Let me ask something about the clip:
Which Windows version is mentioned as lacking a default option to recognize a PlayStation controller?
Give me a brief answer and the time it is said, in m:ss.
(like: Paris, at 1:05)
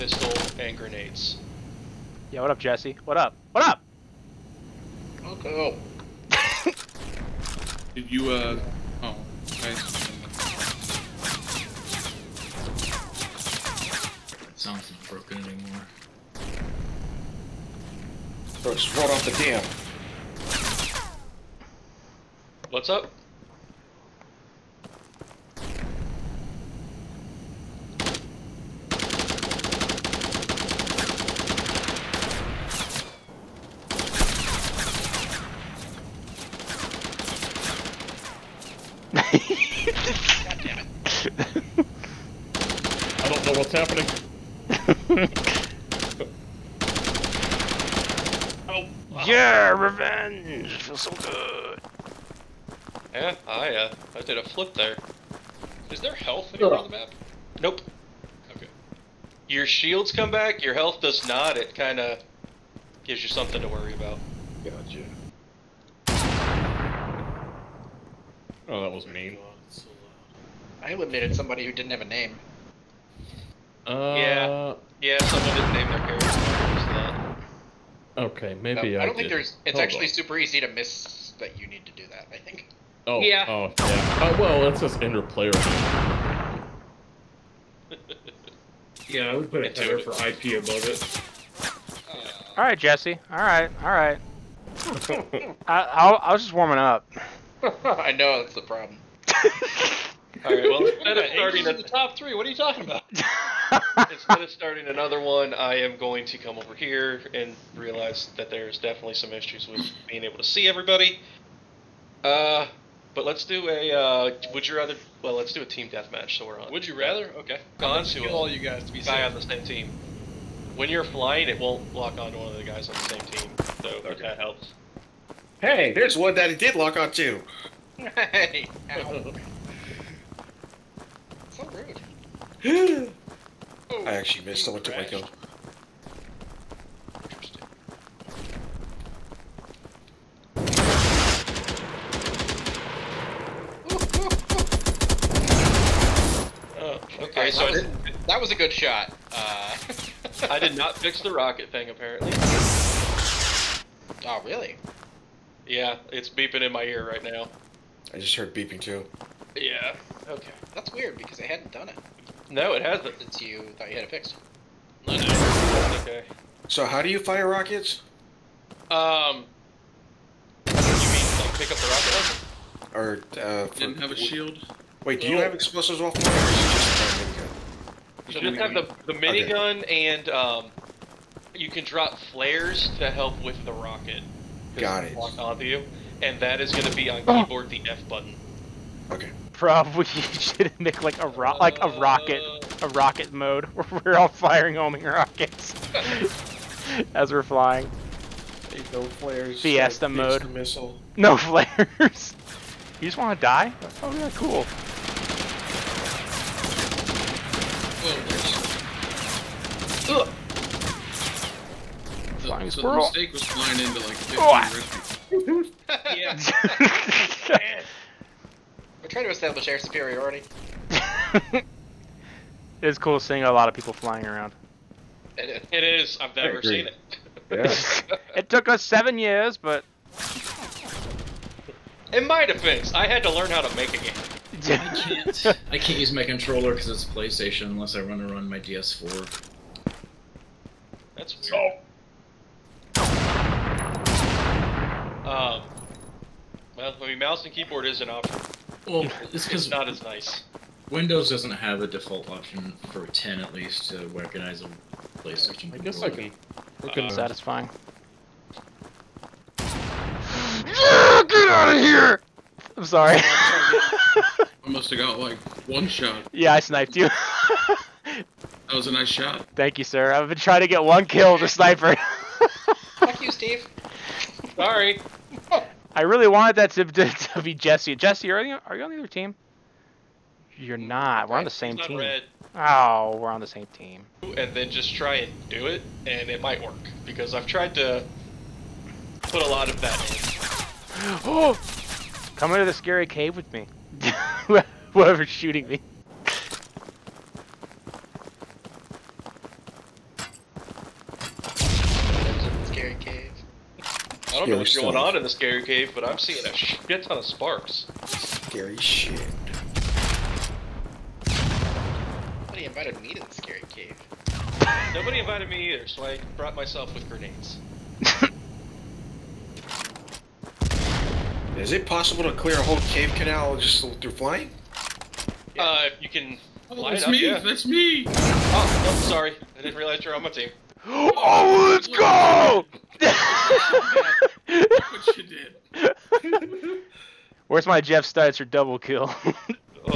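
10, at 4:13.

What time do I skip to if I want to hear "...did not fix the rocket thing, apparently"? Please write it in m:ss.
2:30.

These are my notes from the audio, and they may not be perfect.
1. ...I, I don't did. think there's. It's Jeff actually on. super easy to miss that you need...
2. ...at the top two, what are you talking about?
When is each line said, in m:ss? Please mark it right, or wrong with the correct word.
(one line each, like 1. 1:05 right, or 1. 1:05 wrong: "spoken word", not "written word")
1. 1:18 wrong: "Hold", not "Jeff"
2. 1:41 wrong: "three", not "two".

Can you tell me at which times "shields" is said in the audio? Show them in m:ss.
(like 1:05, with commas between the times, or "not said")
0:59, 2:54.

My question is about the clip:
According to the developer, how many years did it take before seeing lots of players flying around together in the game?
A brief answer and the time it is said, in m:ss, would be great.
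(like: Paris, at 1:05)
7, at 3:48.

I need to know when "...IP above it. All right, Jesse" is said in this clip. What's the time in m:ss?
1:30.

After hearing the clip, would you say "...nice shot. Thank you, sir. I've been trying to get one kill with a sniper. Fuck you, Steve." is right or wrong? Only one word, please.
right.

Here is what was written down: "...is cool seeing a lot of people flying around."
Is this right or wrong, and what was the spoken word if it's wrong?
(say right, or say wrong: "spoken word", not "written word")
right.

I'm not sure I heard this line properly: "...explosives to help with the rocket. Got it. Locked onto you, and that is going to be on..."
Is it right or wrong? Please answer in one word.
wrong.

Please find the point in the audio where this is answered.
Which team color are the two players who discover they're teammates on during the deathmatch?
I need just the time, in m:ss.
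4:41.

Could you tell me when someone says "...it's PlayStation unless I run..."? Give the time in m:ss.
3:56.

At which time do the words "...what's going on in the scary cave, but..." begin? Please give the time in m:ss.
5:04.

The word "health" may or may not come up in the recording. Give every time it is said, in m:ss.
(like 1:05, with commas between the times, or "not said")
0:56, 1:00.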